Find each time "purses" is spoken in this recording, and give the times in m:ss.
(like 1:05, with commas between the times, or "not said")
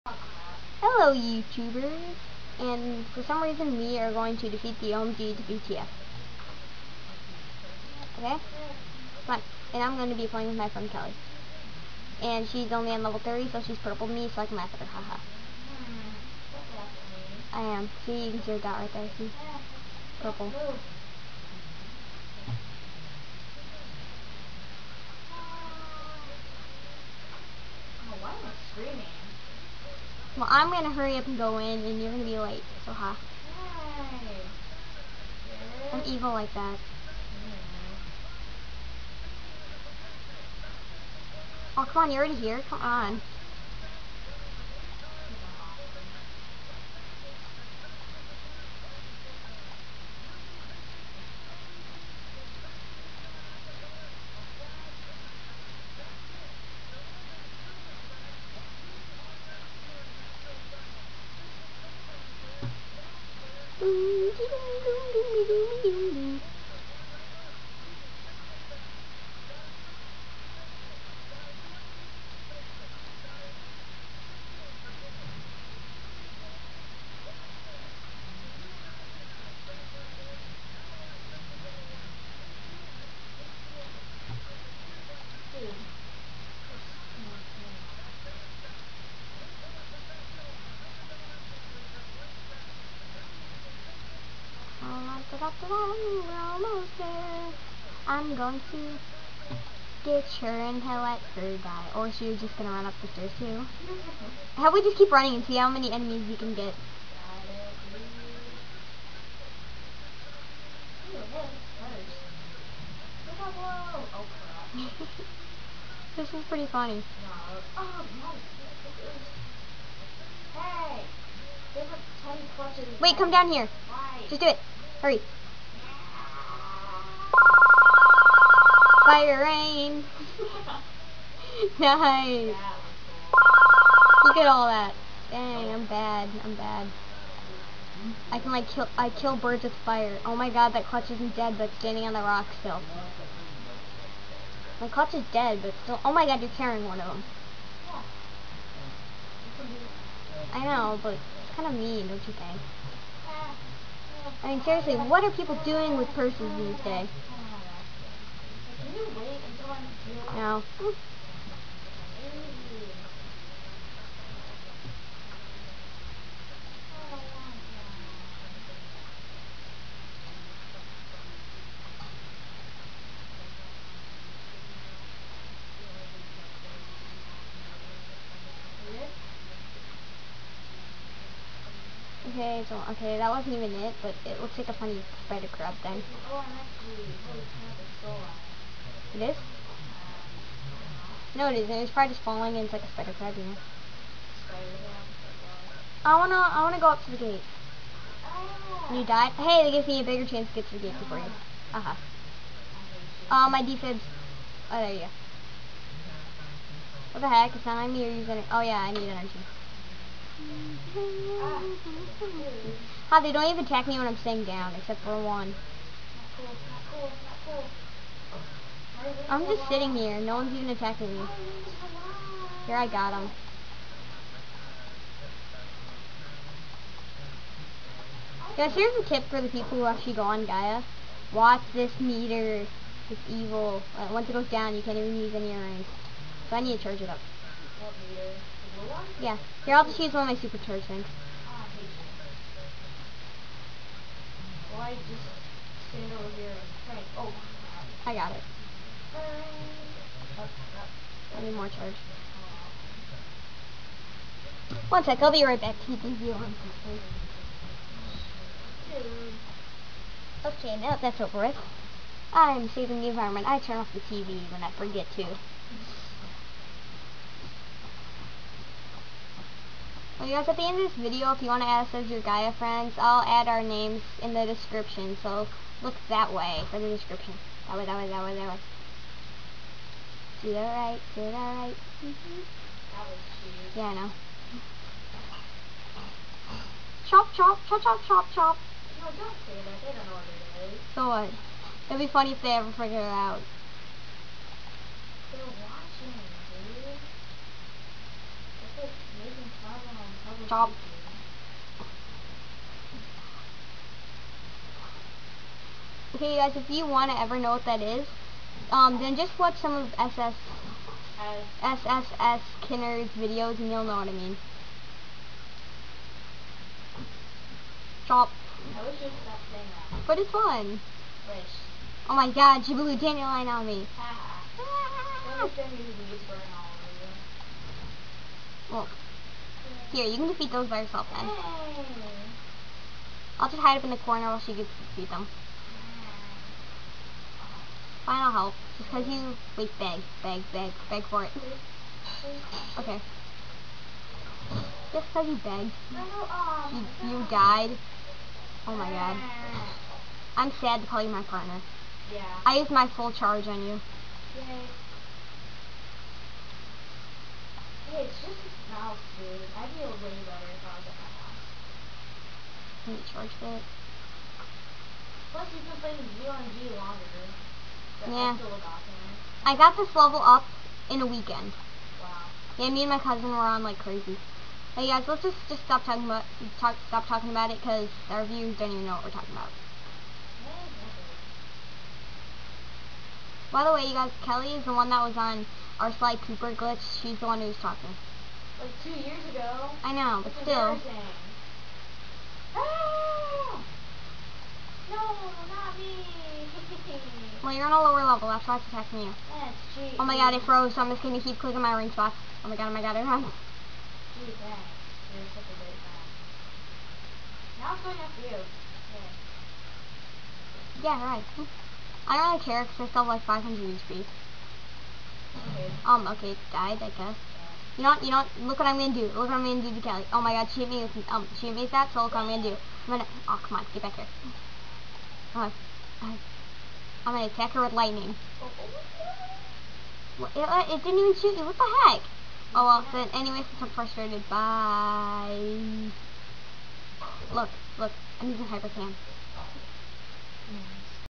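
2:36.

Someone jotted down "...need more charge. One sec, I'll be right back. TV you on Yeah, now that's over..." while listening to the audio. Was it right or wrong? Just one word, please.
wrong.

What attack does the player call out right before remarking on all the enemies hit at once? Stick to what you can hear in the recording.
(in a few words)
Fire rain.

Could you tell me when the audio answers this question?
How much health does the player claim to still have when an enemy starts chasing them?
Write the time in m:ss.
6:53.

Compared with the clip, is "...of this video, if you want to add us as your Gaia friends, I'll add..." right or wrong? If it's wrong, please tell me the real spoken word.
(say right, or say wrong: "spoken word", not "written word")
right.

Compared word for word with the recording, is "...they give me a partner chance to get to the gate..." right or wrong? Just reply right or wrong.
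wrong.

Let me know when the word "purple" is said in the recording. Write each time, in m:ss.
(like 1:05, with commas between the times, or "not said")
0:13, 0:20.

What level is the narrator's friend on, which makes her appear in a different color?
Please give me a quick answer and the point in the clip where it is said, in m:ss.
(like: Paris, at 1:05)
30, at 0:13.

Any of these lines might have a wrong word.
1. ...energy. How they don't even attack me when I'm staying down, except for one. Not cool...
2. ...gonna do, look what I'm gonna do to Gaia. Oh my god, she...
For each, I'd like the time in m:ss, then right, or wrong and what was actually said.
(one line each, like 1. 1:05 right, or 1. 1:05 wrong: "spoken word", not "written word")
1. 3:29 right
2. 6:58 wrong: "Kelly", not "Gaia".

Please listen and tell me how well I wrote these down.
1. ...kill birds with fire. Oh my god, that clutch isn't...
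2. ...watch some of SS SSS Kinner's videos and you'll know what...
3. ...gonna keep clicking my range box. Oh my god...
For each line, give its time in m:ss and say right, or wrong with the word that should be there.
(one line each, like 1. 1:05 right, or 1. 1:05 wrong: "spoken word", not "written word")
1. 2:19 right
2. 5:09 right
3. 6:41 right.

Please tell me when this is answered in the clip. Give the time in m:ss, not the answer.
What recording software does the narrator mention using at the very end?
7:18.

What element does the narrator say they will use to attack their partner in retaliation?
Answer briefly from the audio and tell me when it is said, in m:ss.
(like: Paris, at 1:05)
Lightning, at 7:07.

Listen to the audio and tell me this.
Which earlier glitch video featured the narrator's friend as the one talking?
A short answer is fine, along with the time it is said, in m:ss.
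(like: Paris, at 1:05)
Sly Cooper glitch, at 6:25.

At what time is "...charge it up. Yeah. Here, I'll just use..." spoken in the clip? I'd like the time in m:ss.
3:56.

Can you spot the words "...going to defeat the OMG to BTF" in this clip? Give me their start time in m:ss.
0:04.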